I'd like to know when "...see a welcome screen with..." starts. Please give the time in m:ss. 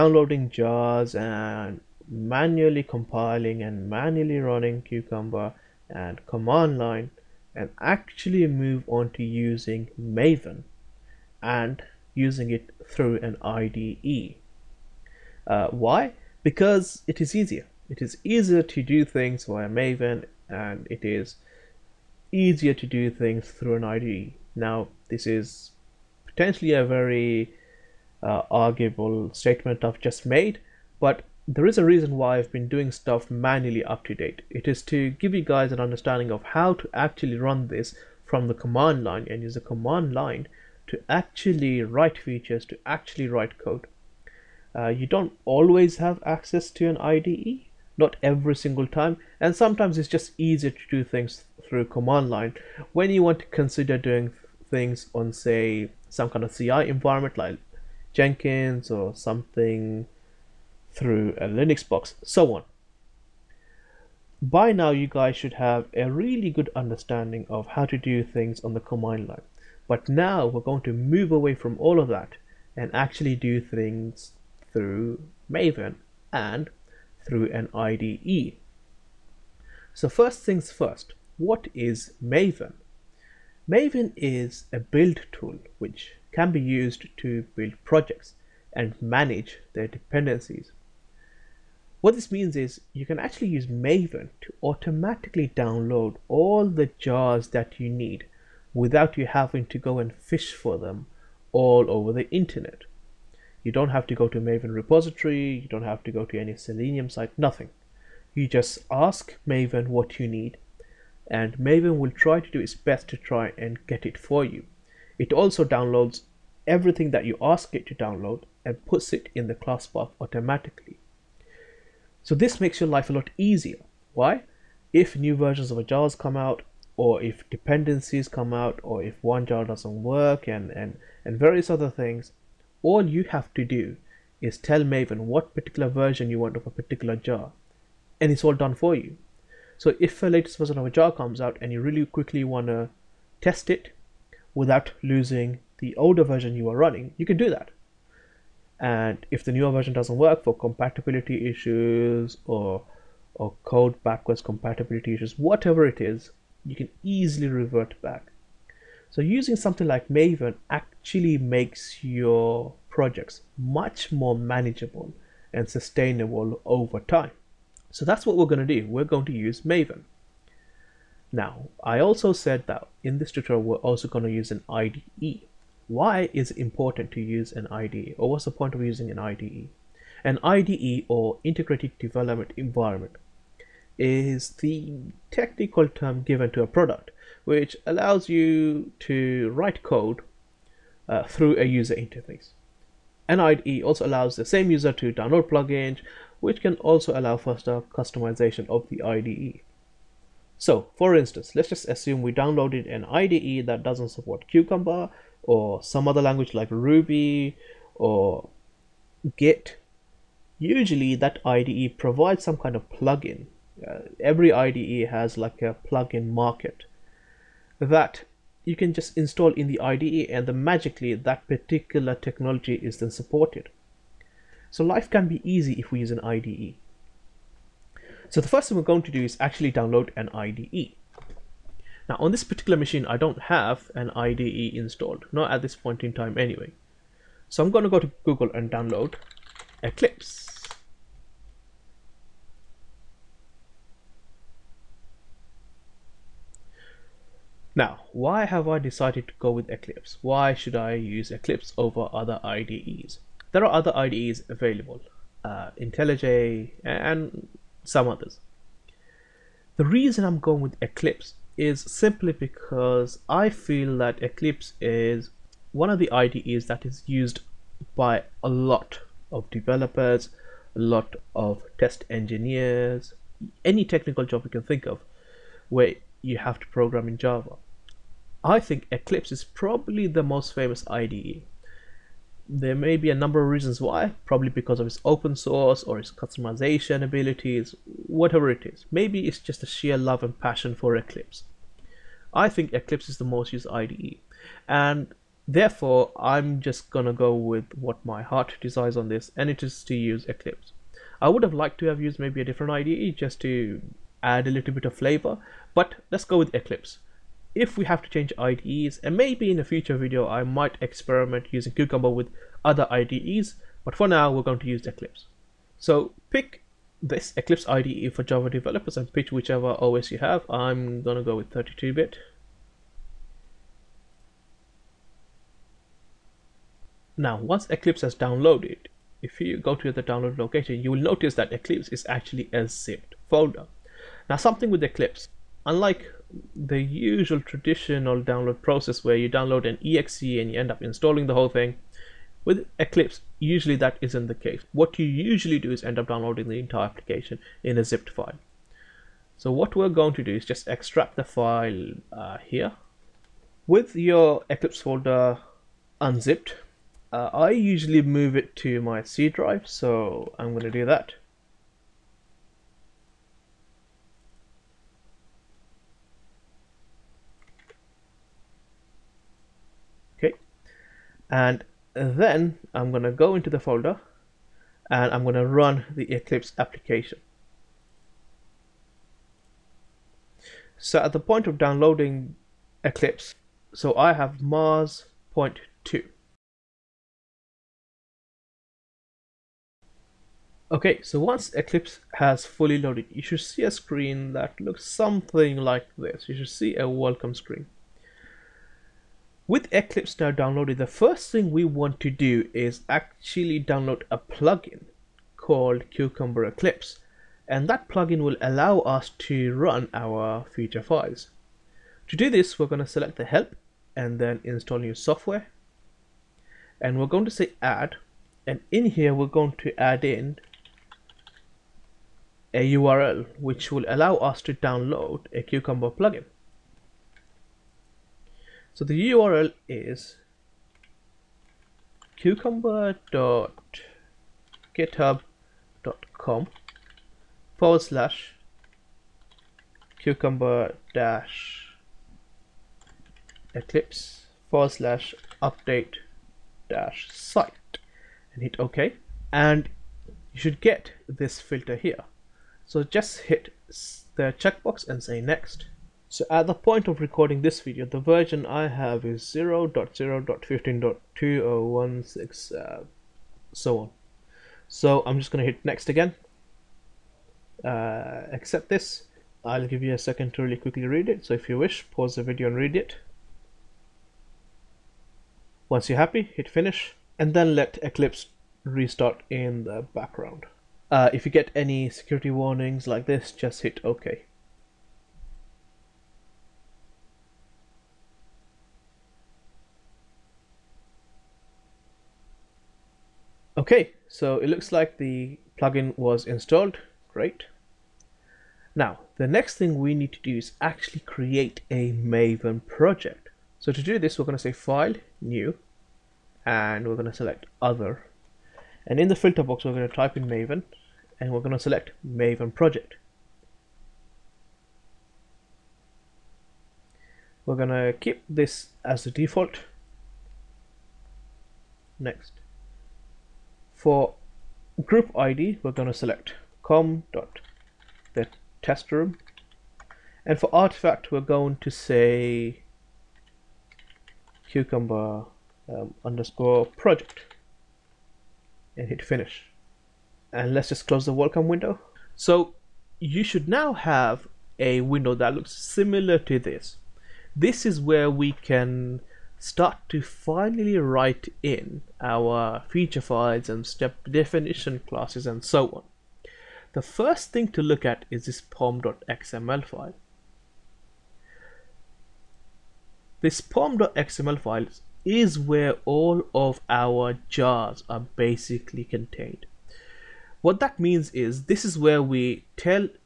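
6:36.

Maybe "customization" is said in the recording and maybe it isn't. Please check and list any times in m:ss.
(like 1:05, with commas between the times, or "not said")
3:17, 4:46.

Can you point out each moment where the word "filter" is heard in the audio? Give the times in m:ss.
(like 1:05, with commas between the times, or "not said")
7:31, 8:29.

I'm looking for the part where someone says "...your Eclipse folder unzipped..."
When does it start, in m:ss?
5:53.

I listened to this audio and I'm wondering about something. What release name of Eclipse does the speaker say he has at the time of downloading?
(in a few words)
Mars.2.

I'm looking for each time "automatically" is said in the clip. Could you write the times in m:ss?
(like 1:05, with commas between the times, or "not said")
1:34, 2:00.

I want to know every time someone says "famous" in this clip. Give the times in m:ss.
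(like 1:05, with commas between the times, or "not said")
4:40.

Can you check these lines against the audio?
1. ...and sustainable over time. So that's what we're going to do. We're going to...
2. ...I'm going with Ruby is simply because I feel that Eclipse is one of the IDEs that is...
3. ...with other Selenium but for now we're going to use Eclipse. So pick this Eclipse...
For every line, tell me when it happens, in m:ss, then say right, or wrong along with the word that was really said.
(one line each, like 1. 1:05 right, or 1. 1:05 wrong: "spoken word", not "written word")
1. 2:45 right
2. 4:20 wrong: "Eclipse", not "Ruby"
3. 5:12 wrong: "IDEs", not "Selenium".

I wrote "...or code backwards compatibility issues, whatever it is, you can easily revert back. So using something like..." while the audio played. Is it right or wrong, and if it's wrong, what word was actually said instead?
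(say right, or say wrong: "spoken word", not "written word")
right.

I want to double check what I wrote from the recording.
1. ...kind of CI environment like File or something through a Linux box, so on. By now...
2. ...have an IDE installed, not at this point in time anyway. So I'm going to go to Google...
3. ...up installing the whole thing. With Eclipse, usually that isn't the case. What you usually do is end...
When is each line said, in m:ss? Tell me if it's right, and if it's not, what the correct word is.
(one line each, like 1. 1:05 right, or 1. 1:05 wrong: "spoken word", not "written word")
1. 0:56 wrong: "Jenkins", not "File"
2. 3:53 right
3. 5:40 right.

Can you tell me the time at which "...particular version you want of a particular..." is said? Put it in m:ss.
2:15.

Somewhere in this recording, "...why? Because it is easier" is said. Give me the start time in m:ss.
0:15.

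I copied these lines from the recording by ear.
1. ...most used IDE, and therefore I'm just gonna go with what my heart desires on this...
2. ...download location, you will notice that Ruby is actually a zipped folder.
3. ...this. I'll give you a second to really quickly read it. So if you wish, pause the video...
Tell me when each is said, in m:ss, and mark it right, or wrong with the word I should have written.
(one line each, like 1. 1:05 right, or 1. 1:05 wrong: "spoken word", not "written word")
1. 4:53 right
2. 5:30 wrong: "Eclipse", not "Ruby"
3. 7:48 right.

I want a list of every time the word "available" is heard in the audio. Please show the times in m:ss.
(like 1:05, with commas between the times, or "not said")
4:14.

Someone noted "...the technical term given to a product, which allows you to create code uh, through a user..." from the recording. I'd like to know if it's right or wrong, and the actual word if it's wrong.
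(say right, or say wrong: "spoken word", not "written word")
wrong: "write", not "create".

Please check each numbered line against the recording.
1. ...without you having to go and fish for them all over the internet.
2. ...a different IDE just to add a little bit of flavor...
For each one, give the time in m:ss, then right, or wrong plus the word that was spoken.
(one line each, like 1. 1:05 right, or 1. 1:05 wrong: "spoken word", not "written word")
1. 1:38 right
2. 5:02 right.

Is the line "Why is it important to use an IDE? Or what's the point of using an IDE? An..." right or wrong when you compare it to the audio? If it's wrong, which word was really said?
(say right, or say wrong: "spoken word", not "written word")
right.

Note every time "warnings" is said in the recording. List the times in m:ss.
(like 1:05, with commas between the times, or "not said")
8:02.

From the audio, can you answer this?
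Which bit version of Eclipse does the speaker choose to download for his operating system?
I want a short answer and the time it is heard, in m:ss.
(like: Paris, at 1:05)
32-bit, at 5:21.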